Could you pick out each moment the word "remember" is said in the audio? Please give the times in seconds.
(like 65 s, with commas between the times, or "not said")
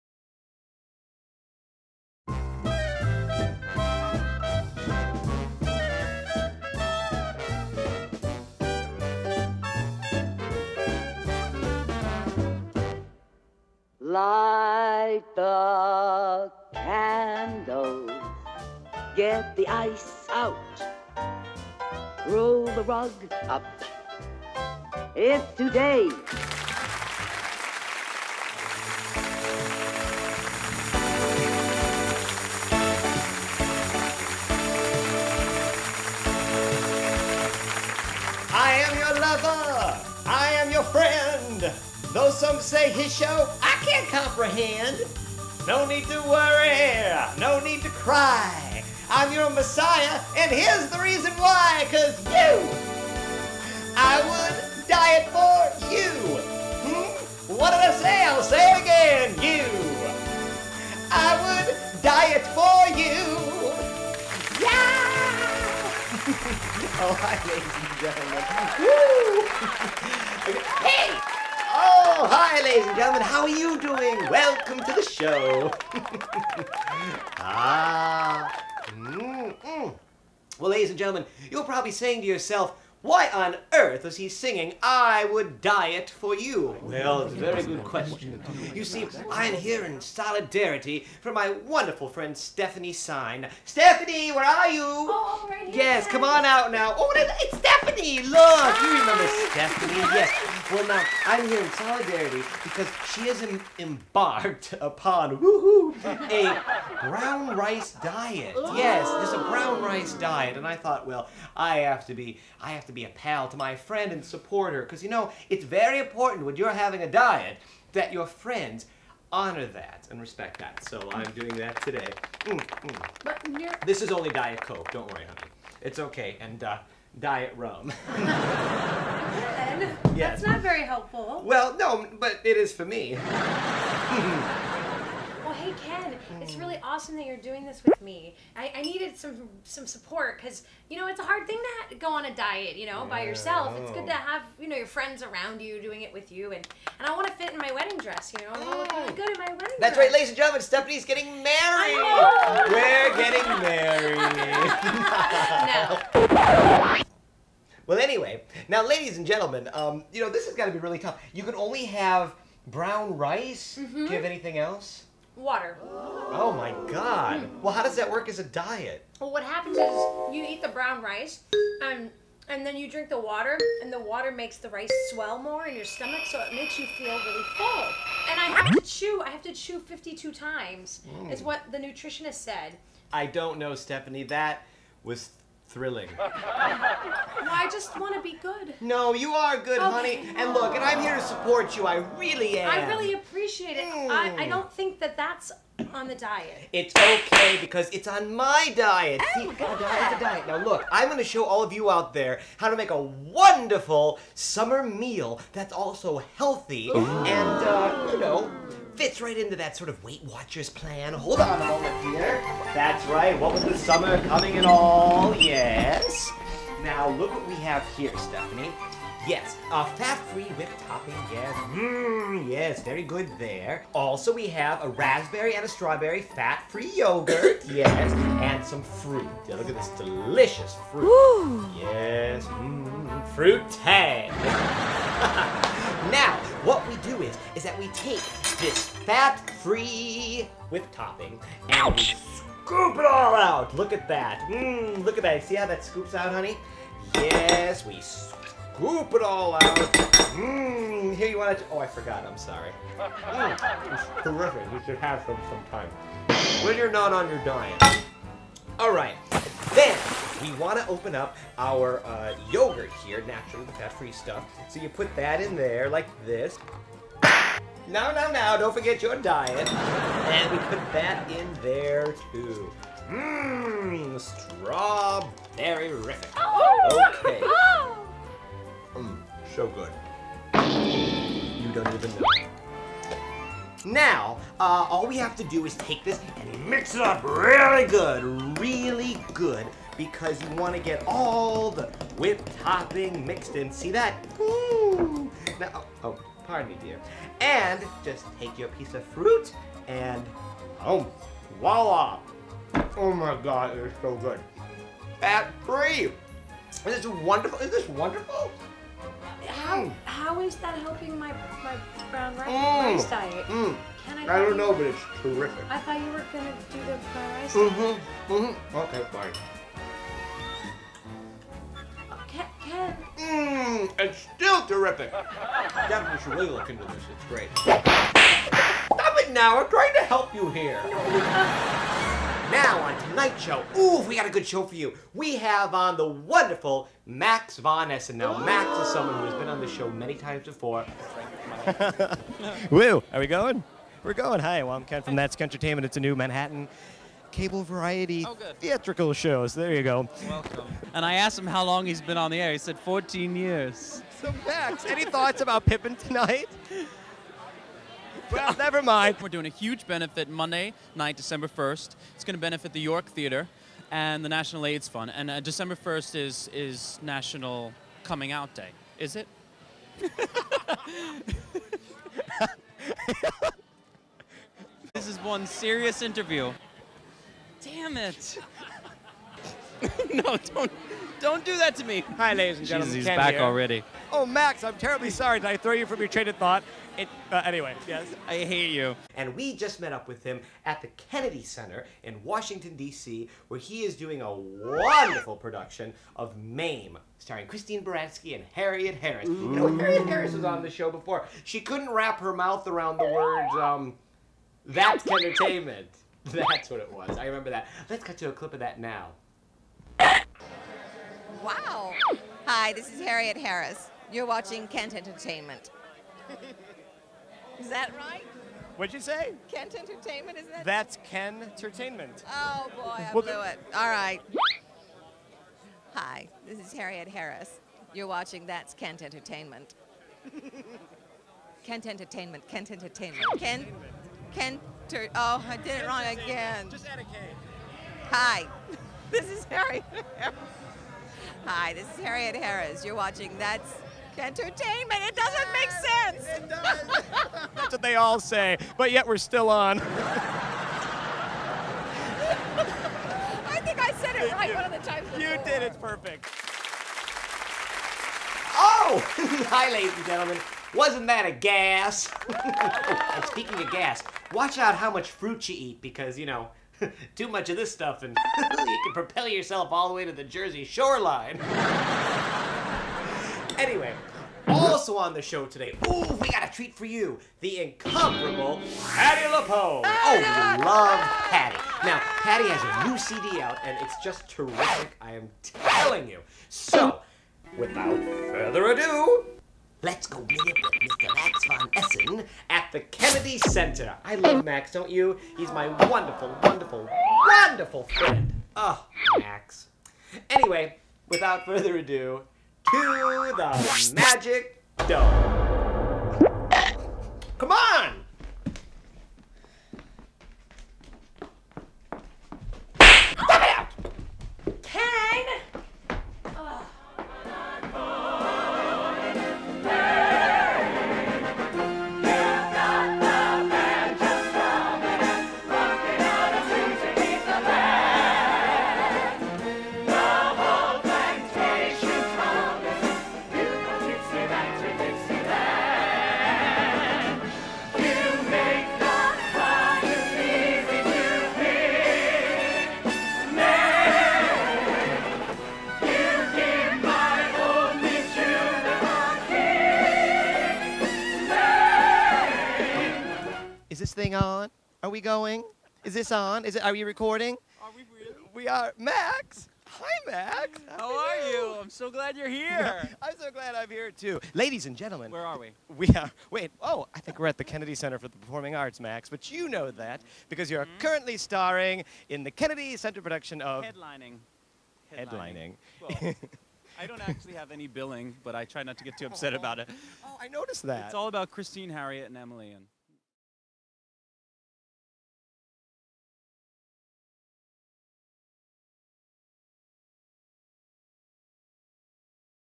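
98 s, 407 s.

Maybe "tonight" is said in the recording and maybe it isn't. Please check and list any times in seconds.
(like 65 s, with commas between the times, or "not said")
333 s, 355 s.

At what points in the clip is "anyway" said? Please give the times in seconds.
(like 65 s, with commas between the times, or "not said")
157 s, 387 s, 473 s, 500 s.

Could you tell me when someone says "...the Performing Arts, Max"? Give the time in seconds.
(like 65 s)
568 s.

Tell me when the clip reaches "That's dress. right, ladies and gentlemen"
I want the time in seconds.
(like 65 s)
149 s.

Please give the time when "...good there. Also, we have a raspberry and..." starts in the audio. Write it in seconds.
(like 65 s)
223 s.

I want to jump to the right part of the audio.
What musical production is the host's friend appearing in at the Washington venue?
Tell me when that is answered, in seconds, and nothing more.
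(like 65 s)
396 s.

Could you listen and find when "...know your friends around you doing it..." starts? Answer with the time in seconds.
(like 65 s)
144 s.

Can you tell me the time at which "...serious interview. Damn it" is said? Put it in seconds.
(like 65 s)
375 s.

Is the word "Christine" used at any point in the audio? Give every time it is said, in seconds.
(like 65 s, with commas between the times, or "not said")
397 s, 581 s.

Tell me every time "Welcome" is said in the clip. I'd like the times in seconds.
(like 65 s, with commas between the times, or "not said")
74 s, 350 s.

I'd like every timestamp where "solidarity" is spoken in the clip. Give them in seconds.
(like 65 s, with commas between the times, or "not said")
90 s, 101 s.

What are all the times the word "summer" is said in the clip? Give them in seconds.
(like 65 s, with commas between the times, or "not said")
204 s, 213 s.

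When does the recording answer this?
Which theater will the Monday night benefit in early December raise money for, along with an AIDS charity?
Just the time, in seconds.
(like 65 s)
362 s.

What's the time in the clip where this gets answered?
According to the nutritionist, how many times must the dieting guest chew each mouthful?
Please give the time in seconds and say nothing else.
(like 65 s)
179 s.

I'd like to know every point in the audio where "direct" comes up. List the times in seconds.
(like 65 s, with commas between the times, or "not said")
not said.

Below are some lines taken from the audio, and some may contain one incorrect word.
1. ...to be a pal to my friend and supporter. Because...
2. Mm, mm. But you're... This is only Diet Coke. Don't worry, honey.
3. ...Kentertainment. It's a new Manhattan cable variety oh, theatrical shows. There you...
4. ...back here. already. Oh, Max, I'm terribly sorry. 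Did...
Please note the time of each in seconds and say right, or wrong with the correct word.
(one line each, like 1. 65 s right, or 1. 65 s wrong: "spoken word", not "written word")
1. 112 s right
2. 122 s right
3. 345 s right
4. 383 s right.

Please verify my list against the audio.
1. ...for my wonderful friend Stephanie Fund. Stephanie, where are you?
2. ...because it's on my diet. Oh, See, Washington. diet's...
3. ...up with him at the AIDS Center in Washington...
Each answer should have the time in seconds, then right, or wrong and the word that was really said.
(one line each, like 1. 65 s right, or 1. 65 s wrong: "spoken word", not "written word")
1. 91 s wrong: "Sine", not "Fund"
2. 197 s wrong: "God", not "Washington"
3. 389 s wrong: "Kennedy", not "AIDS".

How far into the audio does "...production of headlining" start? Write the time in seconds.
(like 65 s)
573 s.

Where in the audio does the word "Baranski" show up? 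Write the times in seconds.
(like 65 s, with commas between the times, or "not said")
397 s.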